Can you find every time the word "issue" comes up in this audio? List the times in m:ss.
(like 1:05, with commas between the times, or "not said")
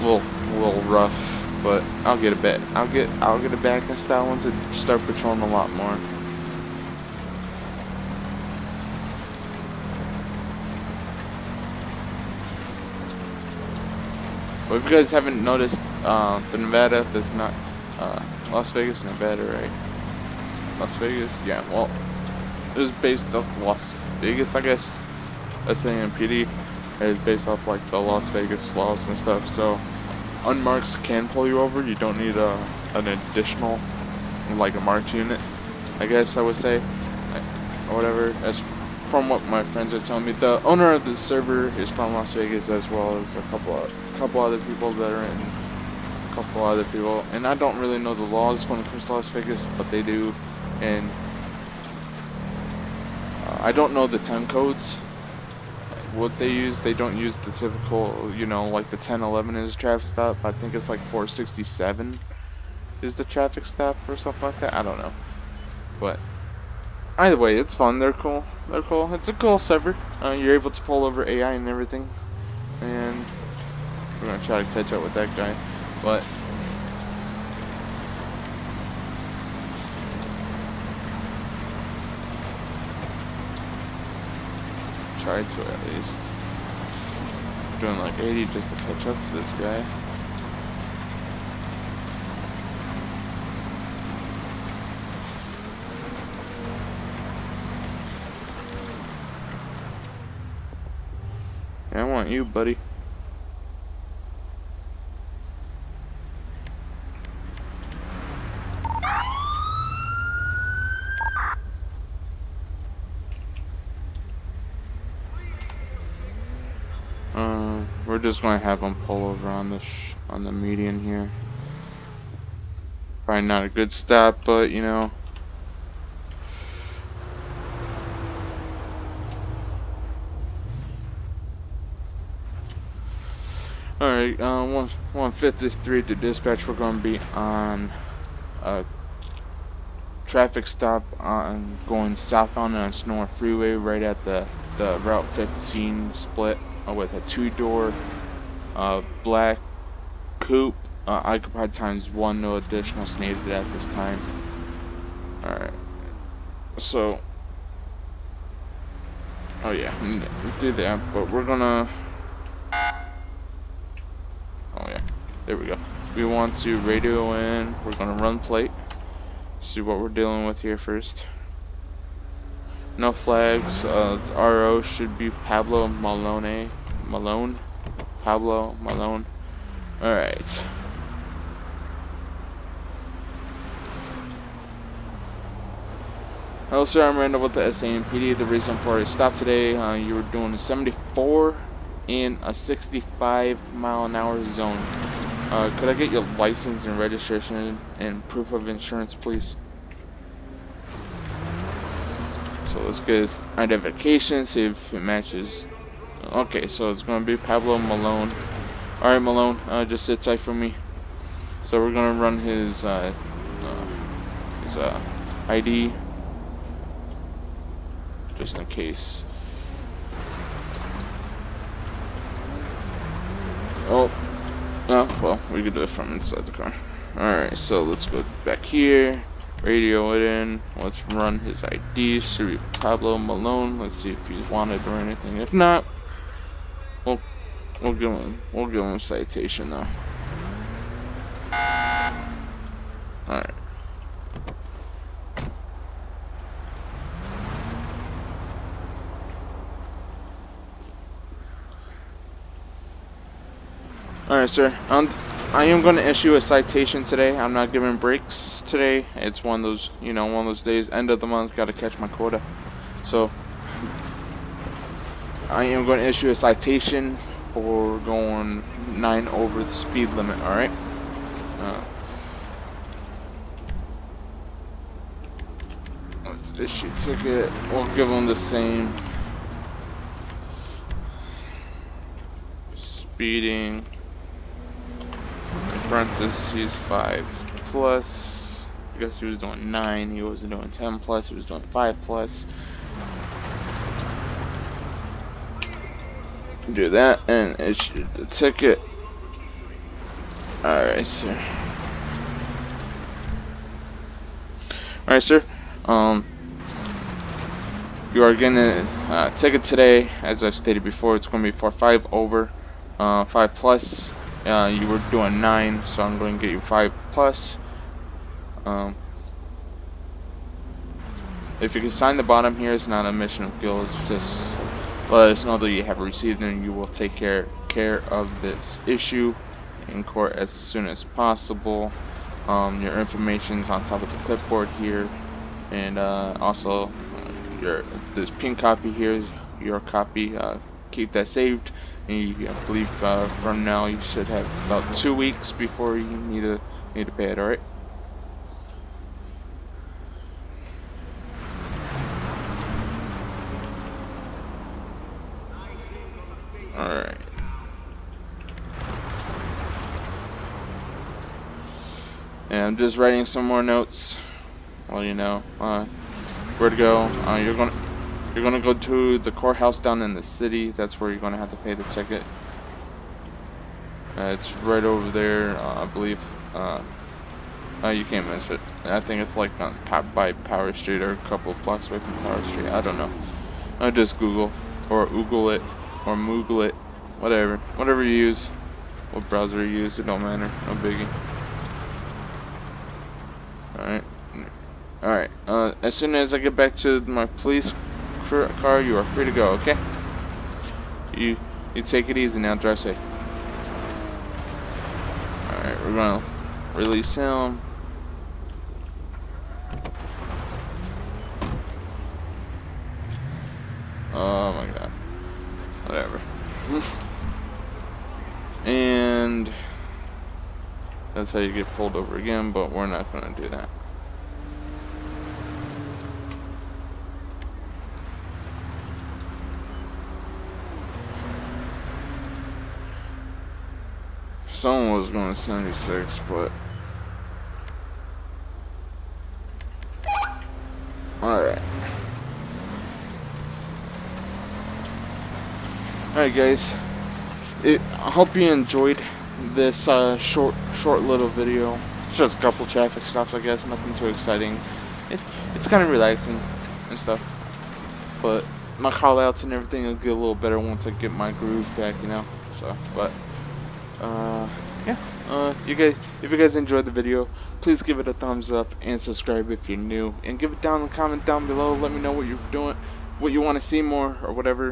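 4:16, 4:26, 4:36, 4:57, 5:28.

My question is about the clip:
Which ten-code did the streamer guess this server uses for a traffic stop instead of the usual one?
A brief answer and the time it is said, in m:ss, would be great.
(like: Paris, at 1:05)
467, at 1:00.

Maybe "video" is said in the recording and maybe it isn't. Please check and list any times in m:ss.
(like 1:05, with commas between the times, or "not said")
7:31, 7:46.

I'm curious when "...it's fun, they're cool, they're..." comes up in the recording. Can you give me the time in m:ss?
1:07.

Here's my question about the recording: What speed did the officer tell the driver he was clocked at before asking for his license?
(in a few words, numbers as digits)
74.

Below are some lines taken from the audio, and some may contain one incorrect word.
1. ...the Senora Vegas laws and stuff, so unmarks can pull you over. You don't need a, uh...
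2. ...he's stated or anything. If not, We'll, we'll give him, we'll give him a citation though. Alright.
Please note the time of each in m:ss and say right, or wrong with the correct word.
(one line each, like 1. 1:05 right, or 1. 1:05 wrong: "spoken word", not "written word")
1. 0:27 wrong: "Las", not "Senora"
2. 3:54 wrong: "wanted", not "stated".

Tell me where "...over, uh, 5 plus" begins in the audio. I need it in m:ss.
5:12.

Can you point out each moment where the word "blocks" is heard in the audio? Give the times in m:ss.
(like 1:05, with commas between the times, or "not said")
6:21.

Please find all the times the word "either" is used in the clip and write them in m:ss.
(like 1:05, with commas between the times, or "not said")
1:07.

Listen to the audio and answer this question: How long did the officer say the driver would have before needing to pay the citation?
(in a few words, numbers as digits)
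Two weeks.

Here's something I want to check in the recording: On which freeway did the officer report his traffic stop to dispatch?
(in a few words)
Senora Freeway.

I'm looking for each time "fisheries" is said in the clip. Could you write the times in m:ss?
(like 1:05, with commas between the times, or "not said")
not said.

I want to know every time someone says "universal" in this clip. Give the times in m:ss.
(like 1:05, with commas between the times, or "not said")
not said.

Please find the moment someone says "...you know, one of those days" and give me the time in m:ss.
4:20.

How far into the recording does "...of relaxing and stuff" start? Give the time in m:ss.
7:35.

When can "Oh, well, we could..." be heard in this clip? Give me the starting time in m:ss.
3:44.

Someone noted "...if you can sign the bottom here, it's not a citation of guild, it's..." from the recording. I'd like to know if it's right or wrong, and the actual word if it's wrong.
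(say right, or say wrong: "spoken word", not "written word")
wrong: "mission", not "citation".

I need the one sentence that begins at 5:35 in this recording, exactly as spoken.
And uh, also, uh, your this pink copy here is your copy.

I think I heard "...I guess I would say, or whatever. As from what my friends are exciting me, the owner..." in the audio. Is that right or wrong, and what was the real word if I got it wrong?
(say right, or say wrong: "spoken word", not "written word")
wrong: "telling", not "exciting".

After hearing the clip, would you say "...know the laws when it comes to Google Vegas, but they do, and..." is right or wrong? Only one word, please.
wrong.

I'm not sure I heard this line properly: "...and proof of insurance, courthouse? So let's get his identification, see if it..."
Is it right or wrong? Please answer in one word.
wrong.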